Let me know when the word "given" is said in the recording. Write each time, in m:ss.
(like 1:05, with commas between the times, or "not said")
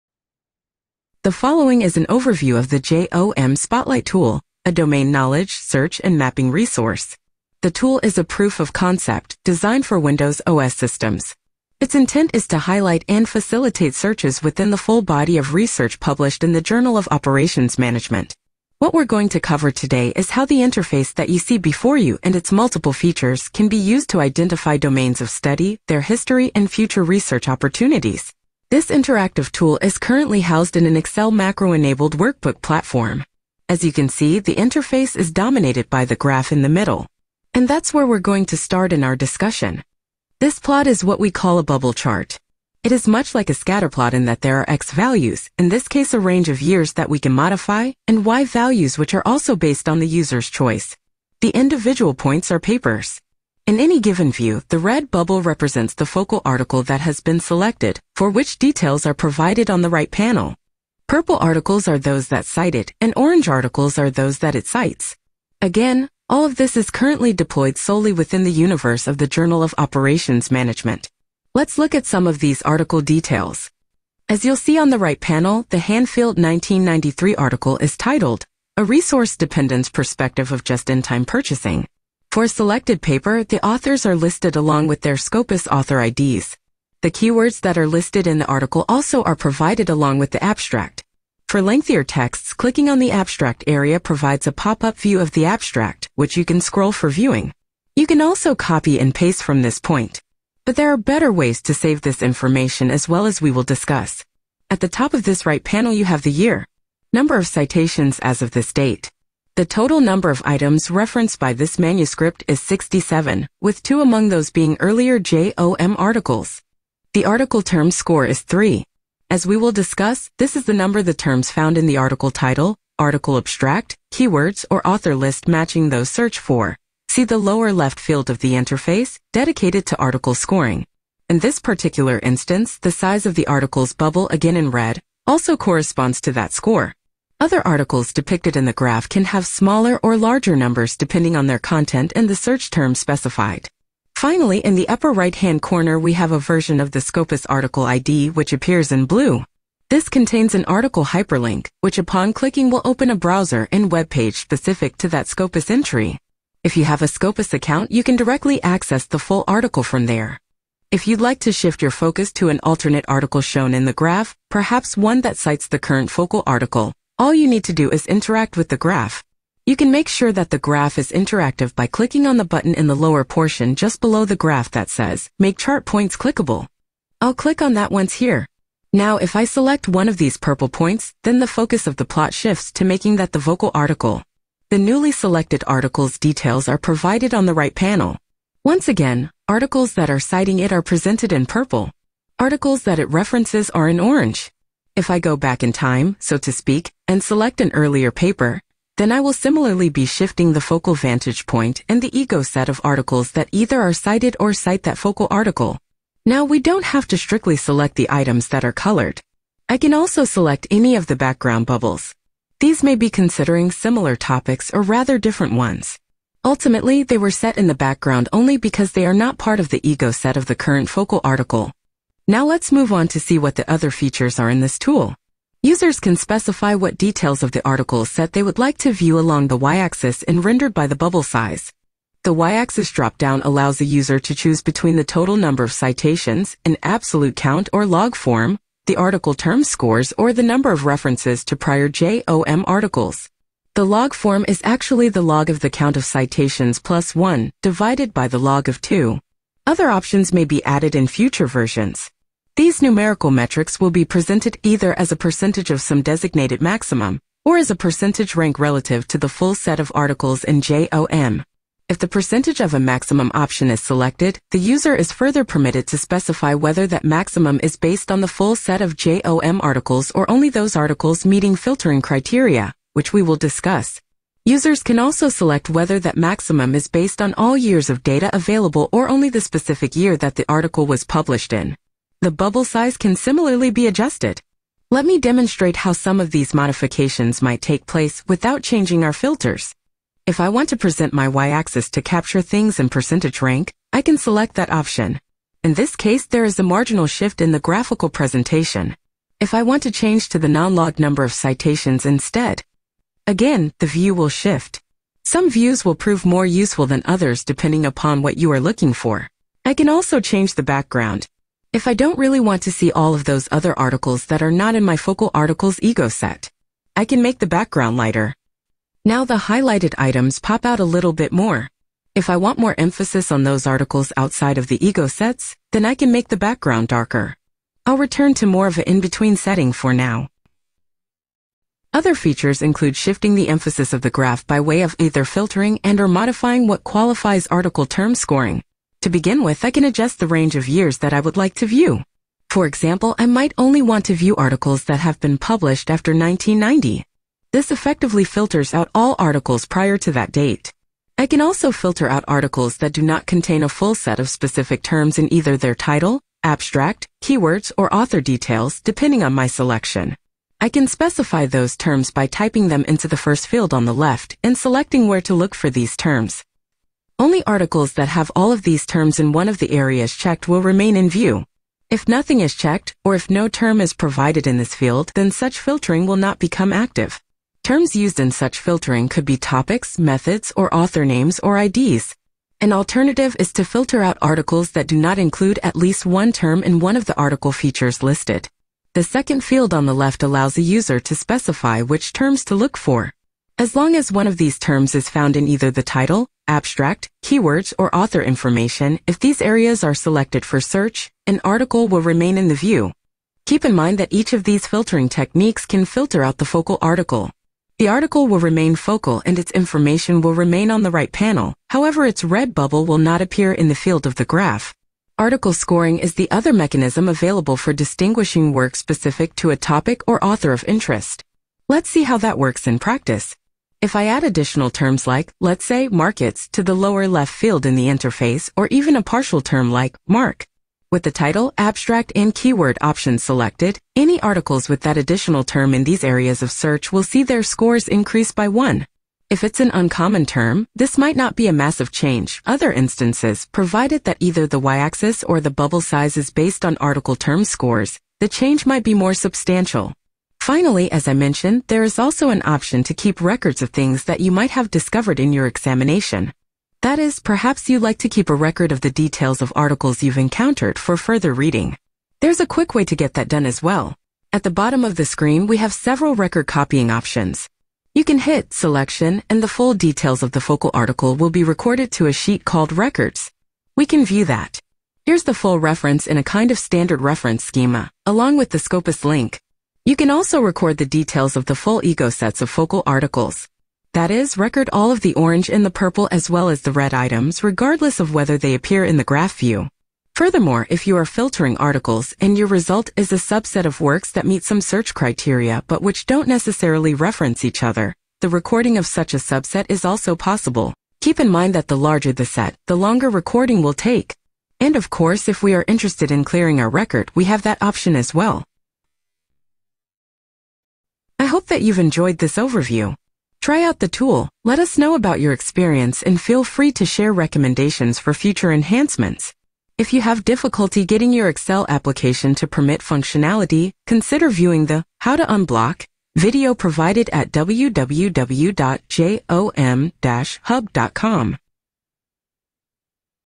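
0:54.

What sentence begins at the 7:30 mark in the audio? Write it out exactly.
Finally, as I mentioned, there is also an option to keep records of things that you might have discovered in your examination.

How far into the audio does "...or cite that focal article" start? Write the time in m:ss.
3:24.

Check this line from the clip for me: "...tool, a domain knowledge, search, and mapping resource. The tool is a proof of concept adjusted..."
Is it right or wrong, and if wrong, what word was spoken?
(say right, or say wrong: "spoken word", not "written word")
wrong: "designed", not "adjusted".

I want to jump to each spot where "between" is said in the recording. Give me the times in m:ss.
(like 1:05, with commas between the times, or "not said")
3:54, 5:28.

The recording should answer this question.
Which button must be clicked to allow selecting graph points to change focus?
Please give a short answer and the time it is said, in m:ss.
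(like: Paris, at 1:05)
Make Chart Points Clickable, at 2:55.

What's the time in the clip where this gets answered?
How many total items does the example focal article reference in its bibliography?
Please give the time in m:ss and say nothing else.
1:52.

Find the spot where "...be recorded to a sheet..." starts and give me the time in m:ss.
7:51.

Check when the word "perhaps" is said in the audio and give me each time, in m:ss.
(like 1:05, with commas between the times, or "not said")
2:44, 7:37.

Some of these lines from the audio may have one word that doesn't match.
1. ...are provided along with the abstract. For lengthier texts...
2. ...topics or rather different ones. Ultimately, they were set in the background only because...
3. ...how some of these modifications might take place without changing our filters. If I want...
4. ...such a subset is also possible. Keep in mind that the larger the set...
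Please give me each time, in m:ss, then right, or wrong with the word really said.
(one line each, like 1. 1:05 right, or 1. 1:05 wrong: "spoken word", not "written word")
1. 1:29 right
2. 3:34 right
3. 4:45 right
4. 8:18 right.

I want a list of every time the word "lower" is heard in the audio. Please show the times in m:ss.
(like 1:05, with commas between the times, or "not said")
2:07, 2:52, 7:06.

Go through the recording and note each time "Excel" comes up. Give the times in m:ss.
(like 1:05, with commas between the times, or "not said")
0:30, 8:41.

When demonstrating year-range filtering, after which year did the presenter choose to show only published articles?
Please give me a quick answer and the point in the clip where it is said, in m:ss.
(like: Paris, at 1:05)
1990, at 5:46.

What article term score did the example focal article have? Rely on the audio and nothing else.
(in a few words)
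3.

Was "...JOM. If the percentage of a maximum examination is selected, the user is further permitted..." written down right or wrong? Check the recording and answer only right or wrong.
wrong.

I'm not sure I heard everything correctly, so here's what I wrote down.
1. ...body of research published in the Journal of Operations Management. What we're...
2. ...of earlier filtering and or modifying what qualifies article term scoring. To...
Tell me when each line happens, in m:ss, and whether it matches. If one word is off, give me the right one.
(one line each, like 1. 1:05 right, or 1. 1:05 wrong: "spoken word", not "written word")
1. 0:15 right
2. 5:34 wrong: "either", not "earlier".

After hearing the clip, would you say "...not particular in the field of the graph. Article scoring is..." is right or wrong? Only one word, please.
wrong.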